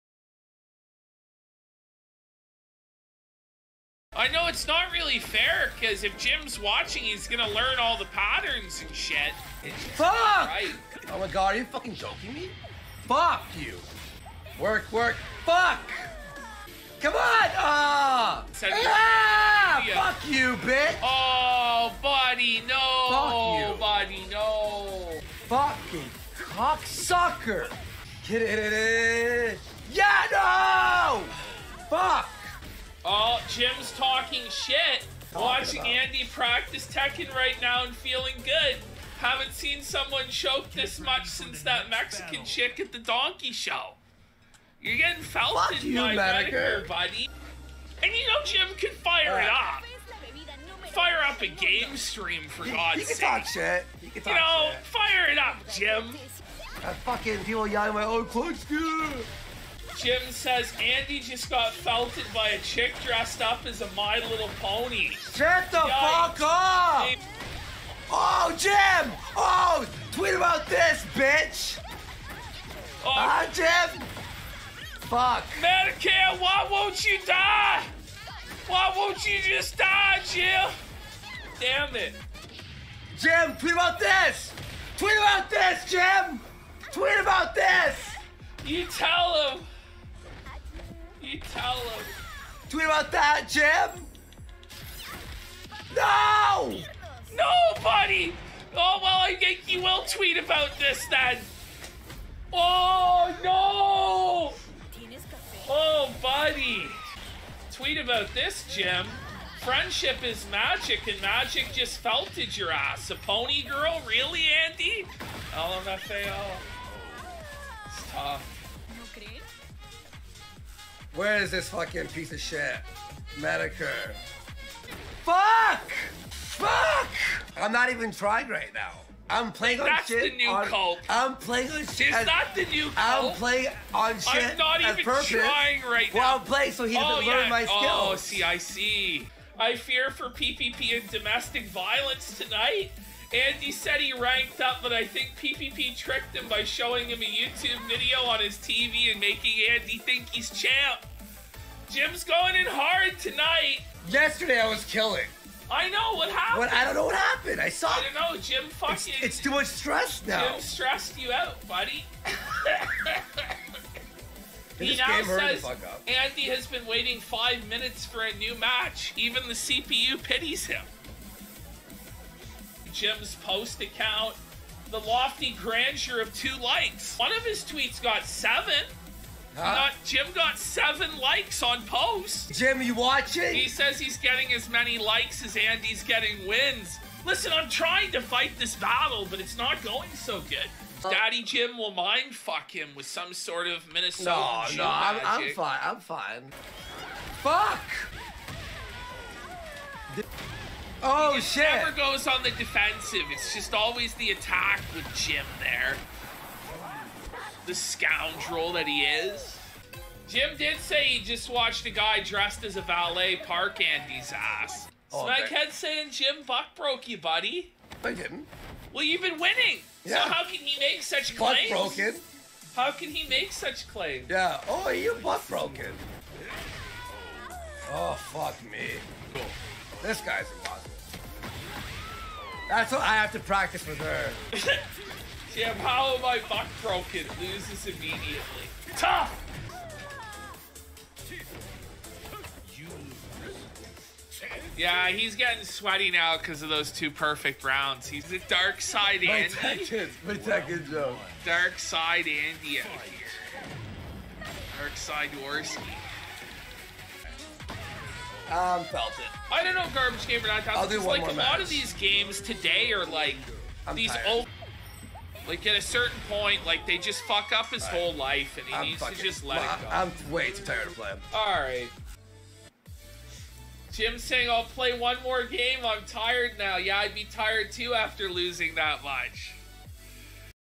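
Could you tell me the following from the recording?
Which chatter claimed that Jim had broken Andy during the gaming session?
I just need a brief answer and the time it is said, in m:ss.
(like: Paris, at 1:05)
Smackhead, at 3:35.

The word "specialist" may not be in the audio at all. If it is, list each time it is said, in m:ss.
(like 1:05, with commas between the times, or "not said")
not said.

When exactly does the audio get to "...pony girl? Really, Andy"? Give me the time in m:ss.
1:53.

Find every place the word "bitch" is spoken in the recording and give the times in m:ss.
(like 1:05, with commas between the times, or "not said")
0:20, 1:11.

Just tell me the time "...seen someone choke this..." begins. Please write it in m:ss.
0:39.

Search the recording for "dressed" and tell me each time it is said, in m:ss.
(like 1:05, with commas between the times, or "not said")
1:03, 3:32.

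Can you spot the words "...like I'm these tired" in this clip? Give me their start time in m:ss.
4:23.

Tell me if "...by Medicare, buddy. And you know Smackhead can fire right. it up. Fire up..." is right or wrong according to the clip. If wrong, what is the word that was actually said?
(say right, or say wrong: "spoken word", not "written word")
wrong: "Jim", not "Smackhead".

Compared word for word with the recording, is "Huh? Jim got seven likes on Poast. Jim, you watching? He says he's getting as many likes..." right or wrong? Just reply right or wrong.
right.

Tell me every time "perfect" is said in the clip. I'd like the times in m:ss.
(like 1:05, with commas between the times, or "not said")
4:07.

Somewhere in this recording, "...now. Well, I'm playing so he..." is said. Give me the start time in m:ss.
2:16.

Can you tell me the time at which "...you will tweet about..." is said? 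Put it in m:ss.
1:39.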